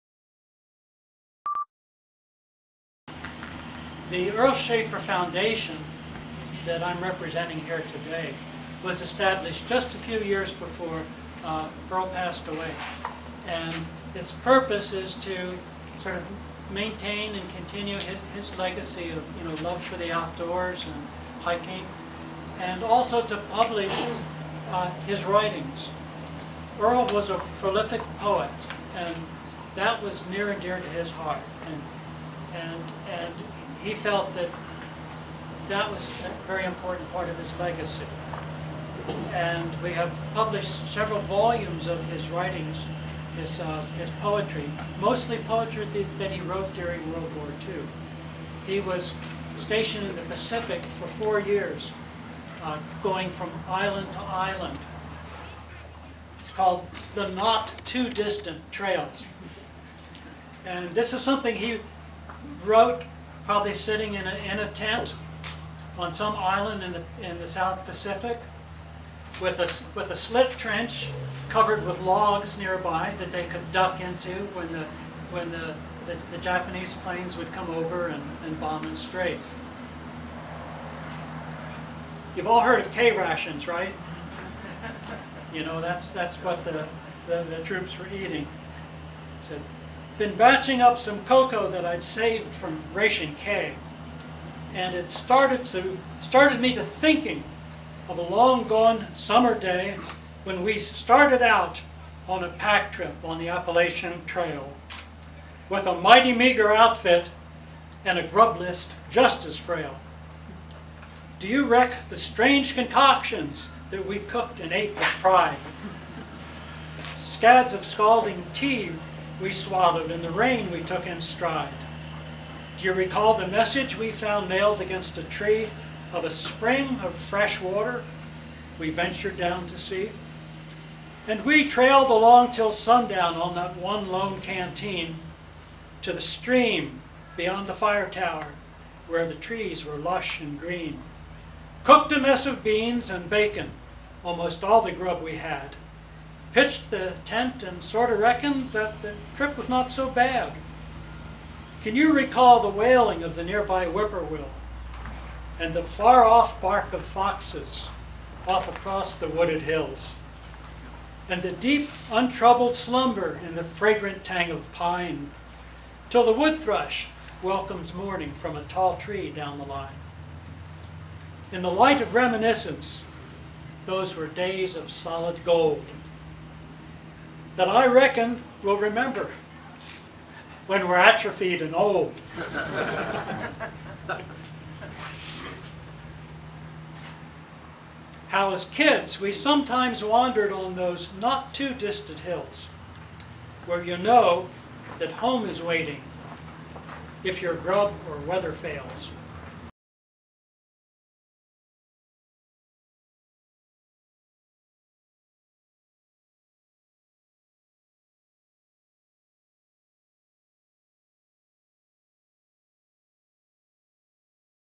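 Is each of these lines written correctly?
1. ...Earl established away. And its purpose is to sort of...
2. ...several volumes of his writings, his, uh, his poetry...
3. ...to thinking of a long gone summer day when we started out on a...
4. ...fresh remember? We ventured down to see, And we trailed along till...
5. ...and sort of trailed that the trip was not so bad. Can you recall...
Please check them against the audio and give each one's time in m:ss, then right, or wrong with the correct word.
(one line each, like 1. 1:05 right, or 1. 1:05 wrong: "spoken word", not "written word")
1. 0:11 wrong: "passed", not "established"
2. 0:40 right
3. 1:36 right
4. 2:07 wrong: "water", not "remember"
5. 2:27 wrong: "reckoned", not "trailed".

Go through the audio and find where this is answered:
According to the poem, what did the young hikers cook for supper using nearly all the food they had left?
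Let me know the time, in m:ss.
2:22.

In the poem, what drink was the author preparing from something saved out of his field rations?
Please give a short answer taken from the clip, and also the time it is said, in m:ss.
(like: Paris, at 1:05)
Cocoa, at 1:31.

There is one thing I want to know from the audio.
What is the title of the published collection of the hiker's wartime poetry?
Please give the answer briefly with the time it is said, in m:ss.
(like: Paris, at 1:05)
The Not Too Distant Trails, at 0:57.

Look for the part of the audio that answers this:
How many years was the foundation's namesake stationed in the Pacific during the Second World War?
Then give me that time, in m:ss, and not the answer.
0:51.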